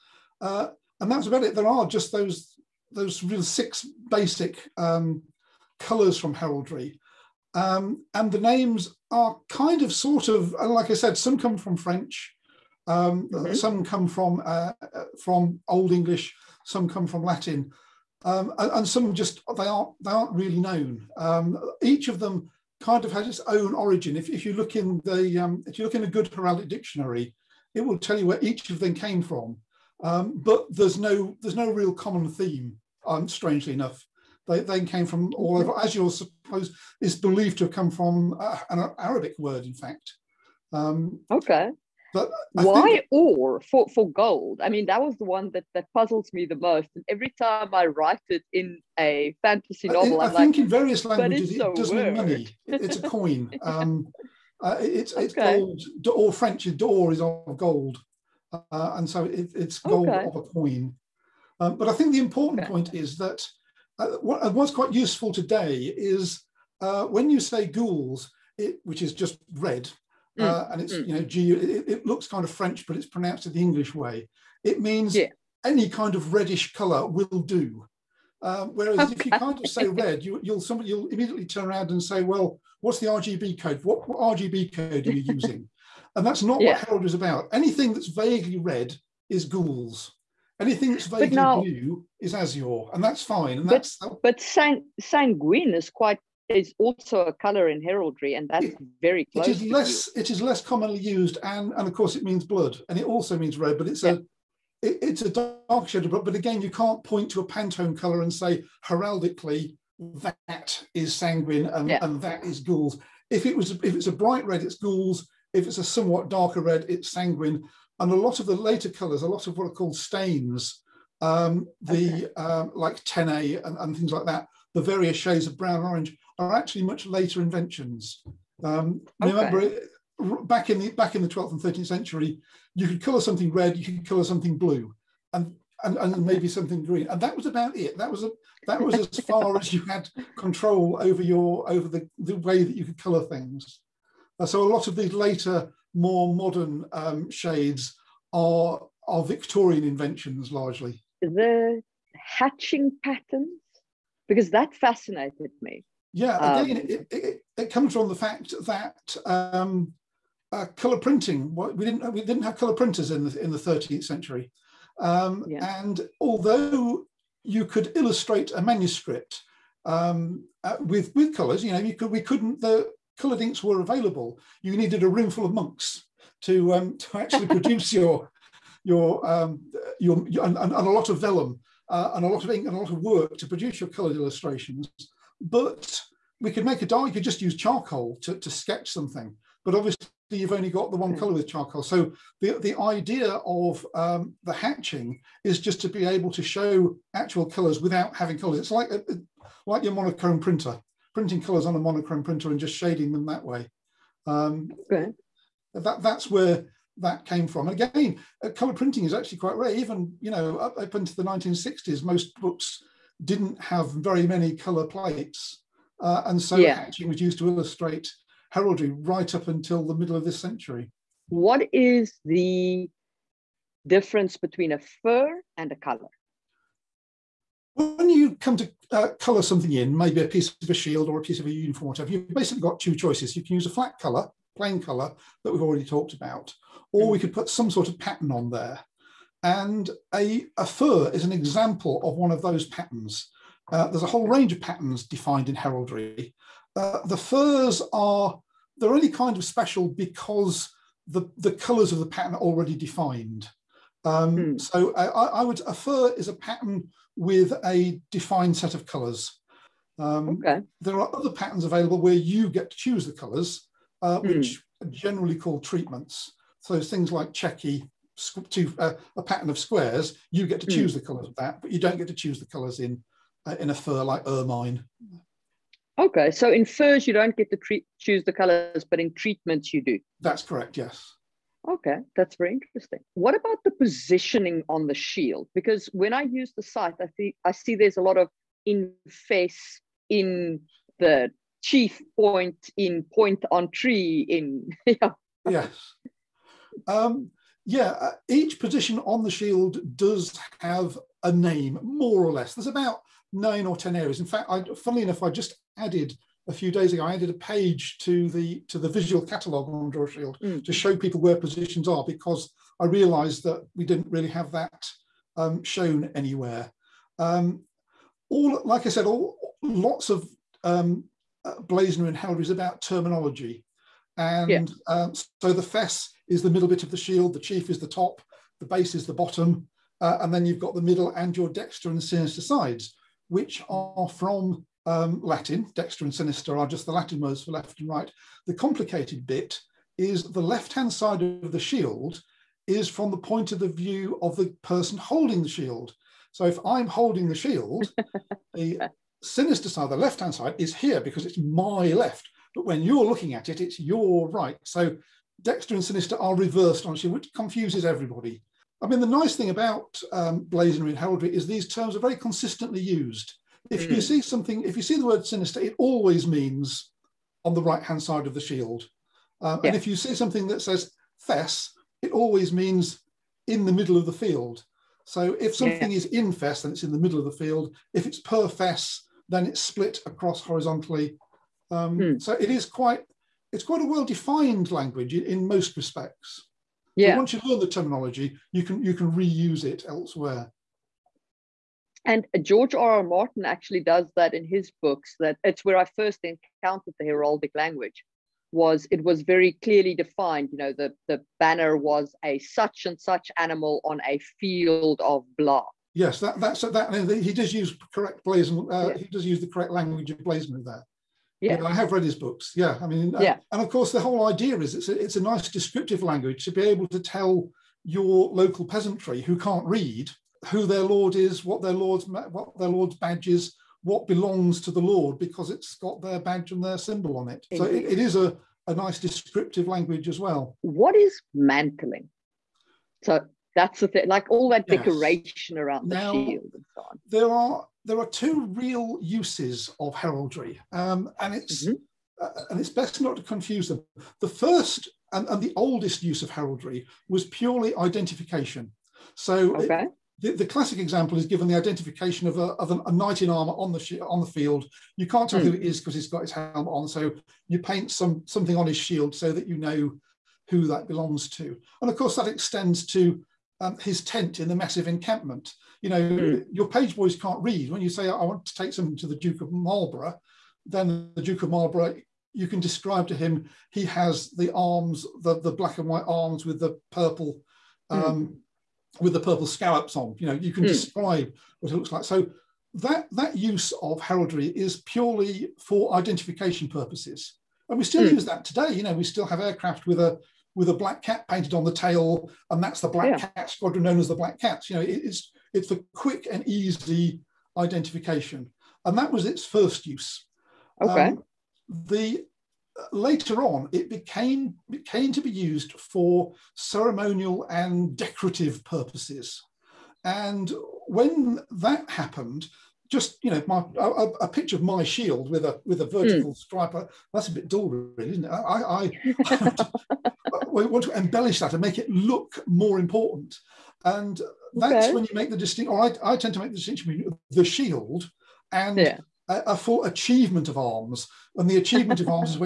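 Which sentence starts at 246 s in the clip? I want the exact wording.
Uh, the furs are, they're only kind of special because the, the colors of the pattern are already defined.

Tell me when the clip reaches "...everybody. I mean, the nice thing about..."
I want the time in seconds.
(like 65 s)
357 s.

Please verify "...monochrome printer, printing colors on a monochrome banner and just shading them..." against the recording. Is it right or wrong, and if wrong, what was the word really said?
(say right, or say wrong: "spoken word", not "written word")
wrong: "printer", not "banner".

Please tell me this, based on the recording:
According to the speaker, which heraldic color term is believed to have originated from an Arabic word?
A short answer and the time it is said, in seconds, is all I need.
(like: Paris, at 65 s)
Azure, at 35 s.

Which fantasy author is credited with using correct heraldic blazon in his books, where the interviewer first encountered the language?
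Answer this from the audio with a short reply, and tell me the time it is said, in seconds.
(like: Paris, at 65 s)
George R. R. Martin, at 392 s.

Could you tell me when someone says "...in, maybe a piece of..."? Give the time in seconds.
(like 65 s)
229 s.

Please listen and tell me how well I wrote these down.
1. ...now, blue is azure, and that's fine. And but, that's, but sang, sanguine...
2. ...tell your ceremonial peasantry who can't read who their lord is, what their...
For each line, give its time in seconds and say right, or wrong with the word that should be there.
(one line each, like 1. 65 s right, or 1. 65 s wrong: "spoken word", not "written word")
1. 91 s right
2. 416 s wrong: "local", not "ceremonial".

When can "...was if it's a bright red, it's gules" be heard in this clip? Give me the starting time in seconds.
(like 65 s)
113 s.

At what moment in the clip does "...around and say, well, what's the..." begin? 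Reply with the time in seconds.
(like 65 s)
81 s.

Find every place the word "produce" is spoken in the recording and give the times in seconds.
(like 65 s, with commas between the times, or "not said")
177 s, 183 s.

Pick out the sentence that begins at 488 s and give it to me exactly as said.
You know, we still have aircraft with a with a black cat painted on the tail, and that's the black yeah.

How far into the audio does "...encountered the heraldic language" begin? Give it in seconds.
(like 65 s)
396 s.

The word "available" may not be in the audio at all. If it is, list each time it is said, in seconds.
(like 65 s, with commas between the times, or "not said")
173 s, 261 s.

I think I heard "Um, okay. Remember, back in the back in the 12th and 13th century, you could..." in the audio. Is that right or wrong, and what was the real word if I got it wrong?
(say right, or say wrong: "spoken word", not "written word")
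right.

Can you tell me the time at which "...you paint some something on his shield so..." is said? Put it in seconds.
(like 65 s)
457 s.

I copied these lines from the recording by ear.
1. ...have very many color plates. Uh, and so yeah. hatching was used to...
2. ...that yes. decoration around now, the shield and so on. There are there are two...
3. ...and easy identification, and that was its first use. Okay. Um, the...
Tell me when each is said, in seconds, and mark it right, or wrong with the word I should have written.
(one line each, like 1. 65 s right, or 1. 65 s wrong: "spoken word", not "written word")
1. 213 s right
2. 434 s right
3. 496 s right.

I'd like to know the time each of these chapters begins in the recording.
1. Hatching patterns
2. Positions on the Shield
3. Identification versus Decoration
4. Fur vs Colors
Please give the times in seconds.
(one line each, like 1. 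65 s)
1. 151 s
2. 282 s
3. 430 s
4. 220 s.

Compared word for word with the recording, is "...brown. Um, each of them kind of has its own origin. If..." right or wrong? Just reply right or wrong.
wrong.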